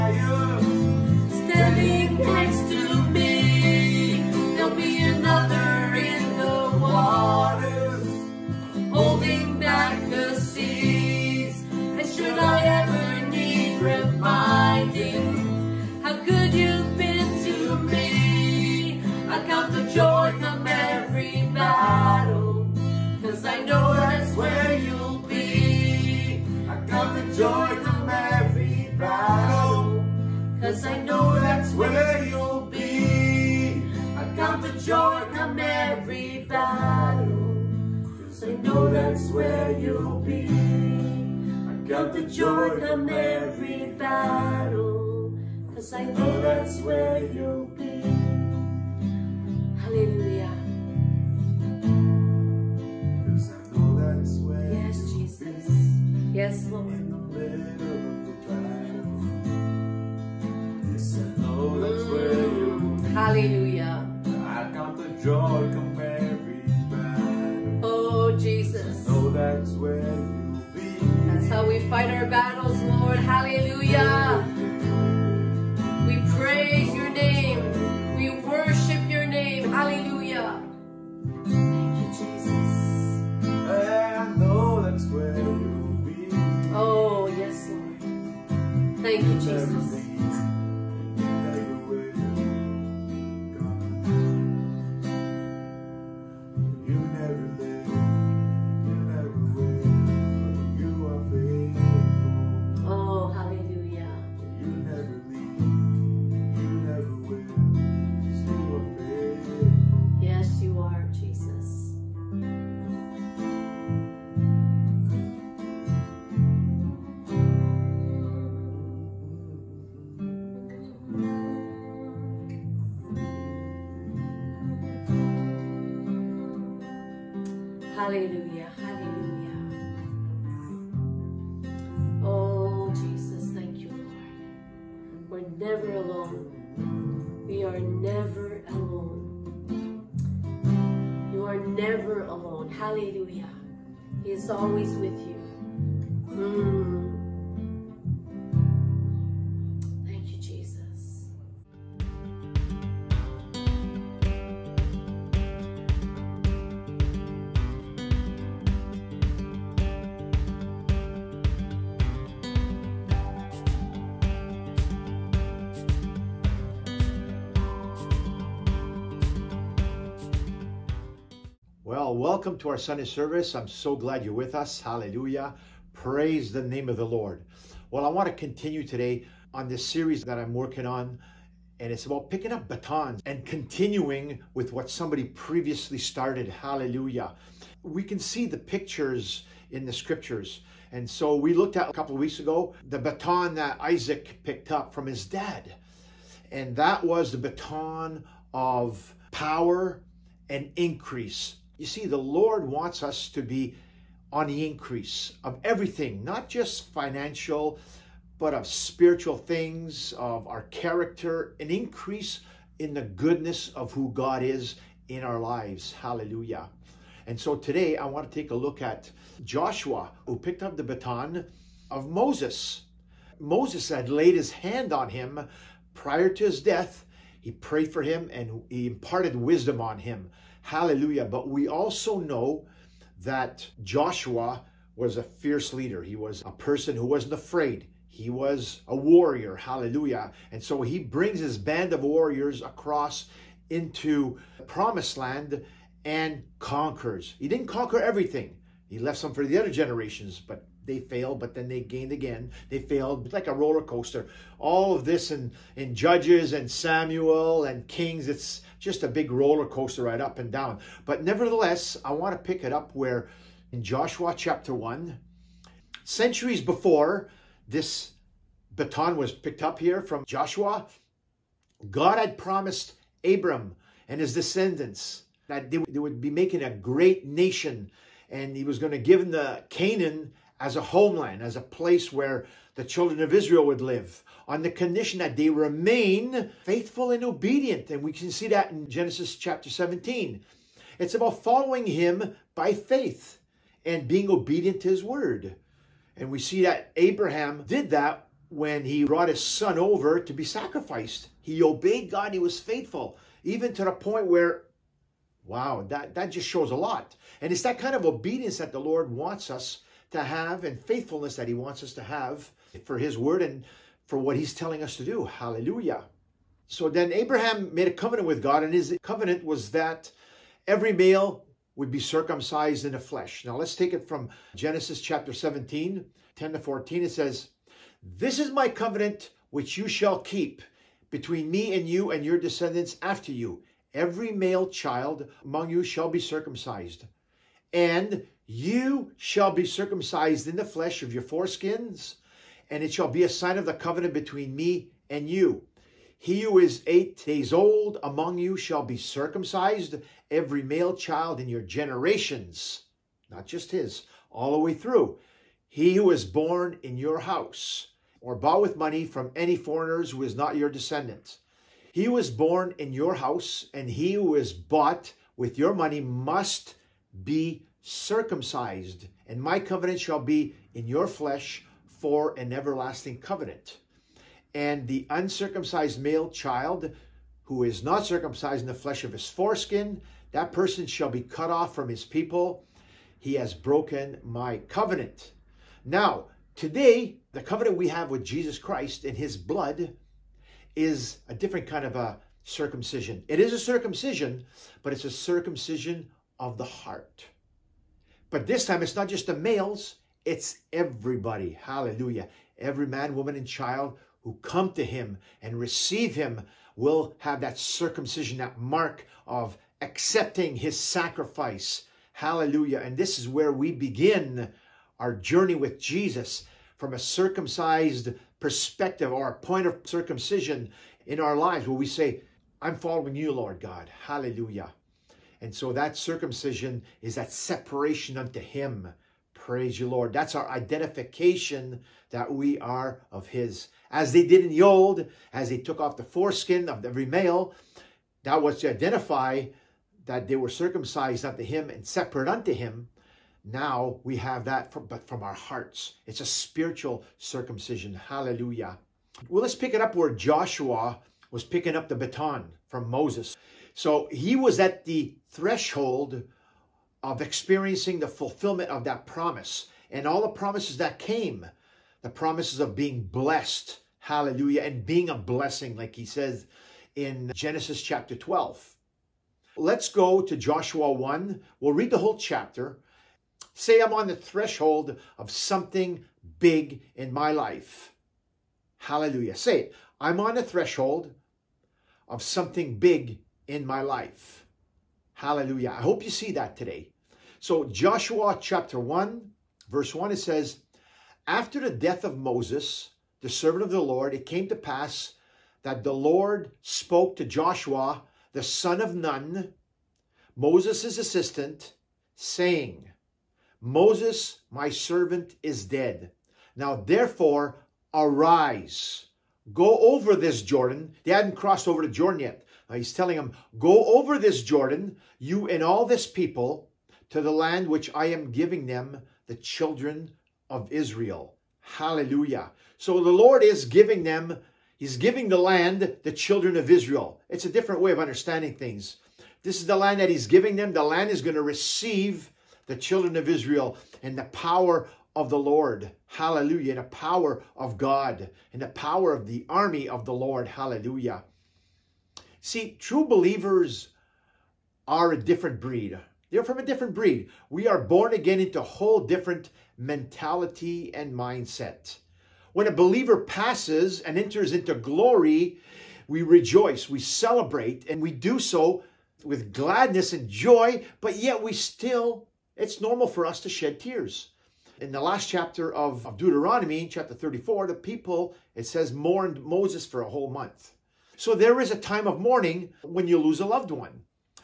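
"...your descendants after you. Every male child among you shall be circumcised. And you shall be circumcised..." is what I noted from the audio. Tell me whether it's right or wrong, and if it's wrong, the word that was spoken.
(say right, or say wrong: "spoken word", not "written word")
right.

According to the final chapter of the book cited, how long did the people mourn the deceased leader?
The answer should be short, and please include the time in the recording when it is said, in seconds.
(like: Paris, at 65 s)
a whole month, at 570 s.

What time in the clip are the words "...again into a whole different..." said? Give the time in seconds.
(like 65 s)
548 s.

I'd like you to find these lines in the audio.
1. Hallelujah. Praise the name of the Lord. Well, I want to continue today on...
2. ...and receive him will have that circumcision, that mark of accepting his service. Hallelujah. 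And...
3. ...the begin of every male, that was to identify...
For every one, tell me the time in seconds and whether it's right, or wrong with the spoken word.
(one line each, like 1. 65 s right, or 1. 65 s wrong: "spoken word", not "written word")
1. 174 s right
2. 405 s wrong: "sacrifice", not "service"
3. 435 s wrong: "foreskin", not "begin".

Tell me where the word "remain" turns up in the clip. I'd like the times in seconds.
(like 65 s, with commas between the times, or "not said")
285 s.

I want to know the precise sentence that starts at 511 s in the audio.
They hadn't crossed over to Jordan yet.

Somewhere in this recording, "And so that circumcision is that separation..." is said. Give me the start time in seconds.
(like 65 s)
425 s.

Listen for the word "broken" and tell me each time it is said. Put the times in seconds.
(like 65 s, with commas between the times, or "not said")
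383 s.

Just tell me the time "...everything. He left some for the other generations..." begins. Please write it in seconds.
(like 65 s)
248 s.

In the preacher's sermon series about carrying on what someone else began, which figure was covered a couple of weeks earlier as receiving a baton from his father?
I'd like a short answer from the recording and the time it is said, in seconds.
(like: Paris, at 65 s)
Isaac, at 193 s.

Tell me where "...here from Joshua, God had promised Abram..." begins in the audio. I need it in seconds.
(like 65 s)
269 s.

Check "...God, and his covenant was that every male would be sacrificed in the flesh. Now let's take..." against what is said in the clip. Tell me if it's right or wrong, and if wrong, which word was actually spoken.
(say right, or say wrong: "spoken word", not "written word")
wrong: "circumcised", not "sacrificed".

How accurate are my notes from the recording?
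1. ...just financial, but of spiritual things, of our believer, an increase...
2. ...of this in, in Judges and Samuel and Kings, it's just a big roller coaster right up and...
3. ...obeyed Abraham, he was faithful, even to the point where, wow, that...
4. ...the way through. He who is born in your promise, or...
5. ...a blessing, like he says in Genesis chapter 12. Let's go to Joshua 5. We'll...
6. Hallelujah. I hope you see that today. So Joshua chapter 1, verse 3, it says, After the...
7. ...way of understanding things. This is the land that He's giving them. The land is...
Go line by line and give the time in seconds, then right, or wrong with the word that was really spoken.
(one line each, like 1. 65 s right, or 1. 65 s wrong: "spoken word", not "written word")
1. 206 s wrong: "character", not "believer"
2. 254 s right
3. 301 s wrong: "God", not "Abraham"
4. 354 s wrong: "house", not "promise"
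5. 465 s wrong: "1", not "5"
6. 485 s wrong: "1", not "3"
7. 527 s right.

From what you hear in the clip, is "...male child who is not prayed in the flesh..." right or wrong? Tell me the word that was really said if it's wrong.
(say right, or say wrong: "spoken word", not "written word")
wrong: "circumcised", not "prayed".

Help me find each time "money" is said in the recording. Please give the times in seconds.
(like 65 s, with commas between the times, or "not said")
358 s, 365 s.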